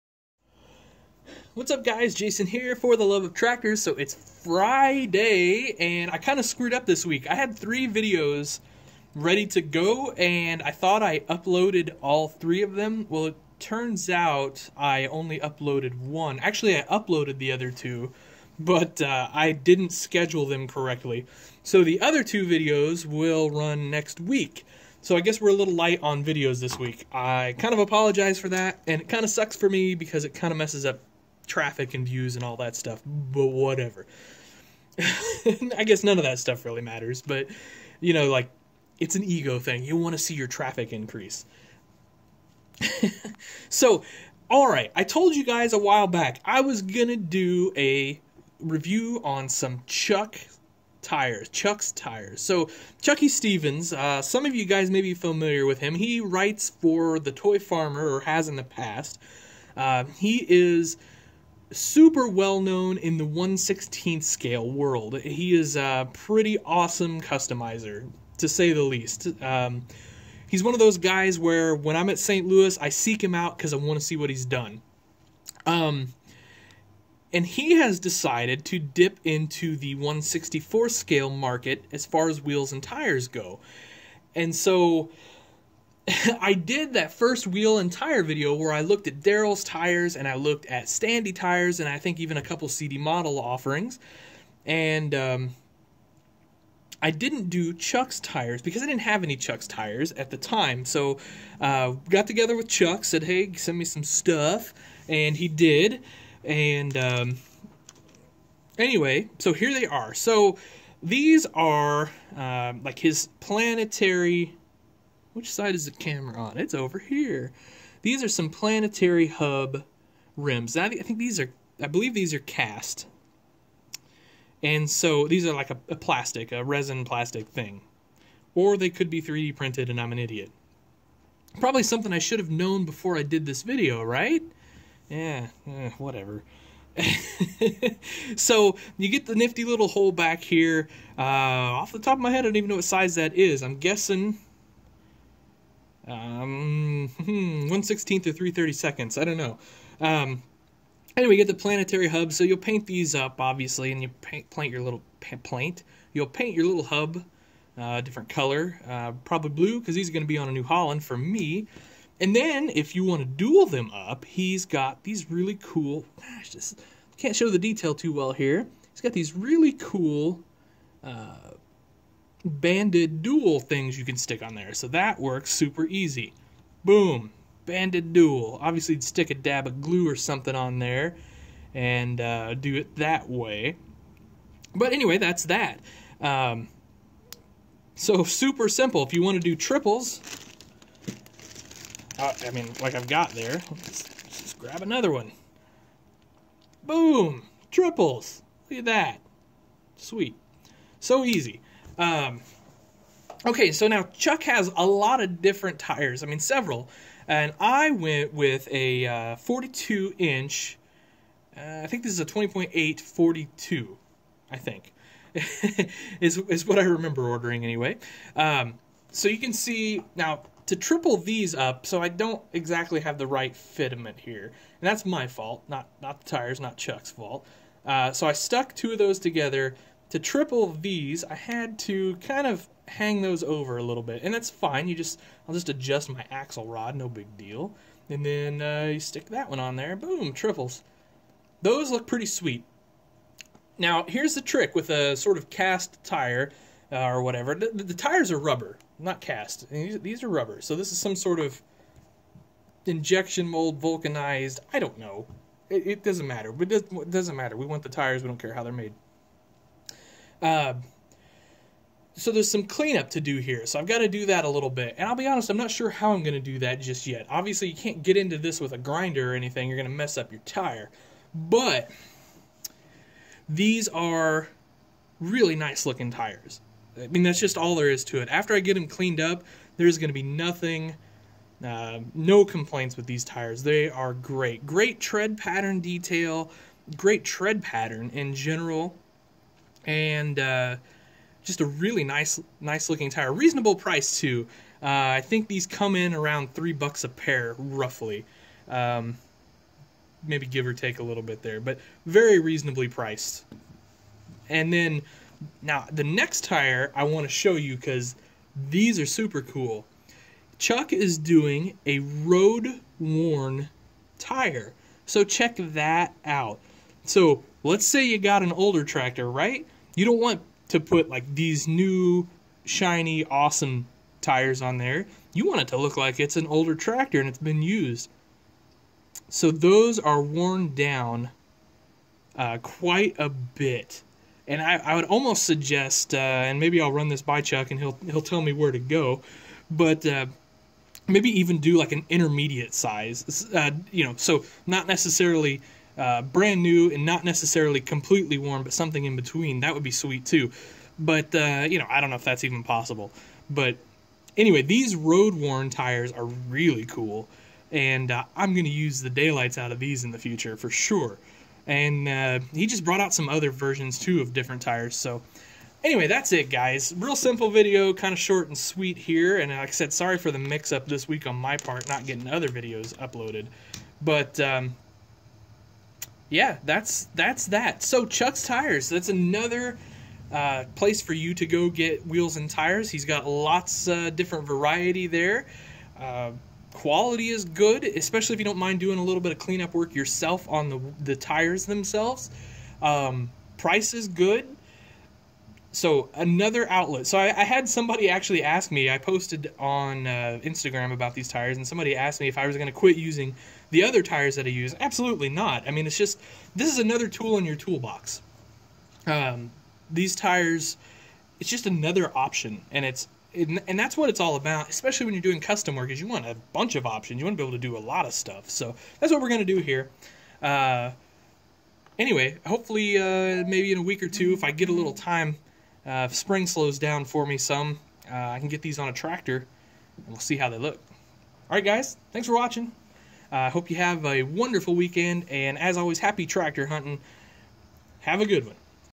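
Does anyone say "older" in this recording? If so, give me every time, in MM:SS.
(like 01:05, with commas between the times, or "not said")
05:18, 05:26.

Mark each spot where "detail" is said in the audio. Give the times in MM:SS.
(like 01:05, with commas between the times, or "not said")
02:47, 04:45.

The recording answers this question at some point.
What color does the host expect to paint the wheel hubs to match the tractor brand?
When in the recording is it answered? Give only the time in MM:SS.
02:39.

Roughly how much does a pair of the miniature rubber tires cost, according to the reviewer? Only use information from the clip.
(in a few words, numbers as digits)
$3.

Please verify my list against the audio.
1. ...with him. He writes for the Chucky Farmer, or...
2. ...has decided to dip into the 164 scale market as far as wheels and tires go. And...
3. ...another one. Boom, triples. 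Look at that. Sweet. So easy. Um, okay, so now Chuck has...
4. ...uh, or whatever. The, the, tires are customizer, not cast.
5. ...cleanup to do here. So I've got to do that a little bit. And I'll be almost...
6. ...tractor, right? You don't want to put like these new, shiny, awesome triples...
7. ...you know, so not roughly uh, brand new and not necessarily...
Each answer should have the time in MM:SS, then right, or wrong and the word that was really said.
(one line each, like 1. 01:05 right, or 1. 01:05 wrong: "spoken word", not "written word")
1. 00:55 wrong: "Toy", not "Chucky"
2. 01:17 right
3. 03:14 right
4. 04:06 wrong: "rubber", not "customizer"
5. 04:22 wrong: "honest", not "almost"
6. 05:18 wrong: "tires", not "triples"
7. 05:43 wrong: "necessarily", not "roughly".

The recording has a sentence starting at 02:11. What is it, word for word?
Probably something I should have known before I did this video, right?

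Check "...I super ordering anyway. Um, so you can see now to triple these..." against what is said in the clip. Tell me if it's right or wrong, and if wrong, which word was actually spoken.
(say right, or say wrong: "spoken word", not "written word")
wrong: "remember", not "super".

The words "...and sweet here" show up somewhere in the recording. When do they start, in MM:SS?
06:08.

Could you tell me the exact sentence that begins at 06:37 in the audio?
So I, I, had somebody actually ask me.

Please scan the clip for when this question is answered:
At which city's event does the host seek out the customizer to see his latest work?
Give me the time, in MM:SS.
01:12.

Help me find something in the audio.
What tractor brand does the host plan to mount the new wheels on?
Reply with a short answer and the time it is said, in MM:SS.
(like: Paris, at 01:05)
New Holland, at 02:40.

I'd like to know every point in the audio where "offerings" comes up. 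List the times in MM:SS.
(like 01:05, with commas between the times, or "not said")
01:33.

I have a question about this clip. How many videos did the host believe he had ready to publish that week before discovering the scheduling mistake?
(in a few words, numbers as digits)
3.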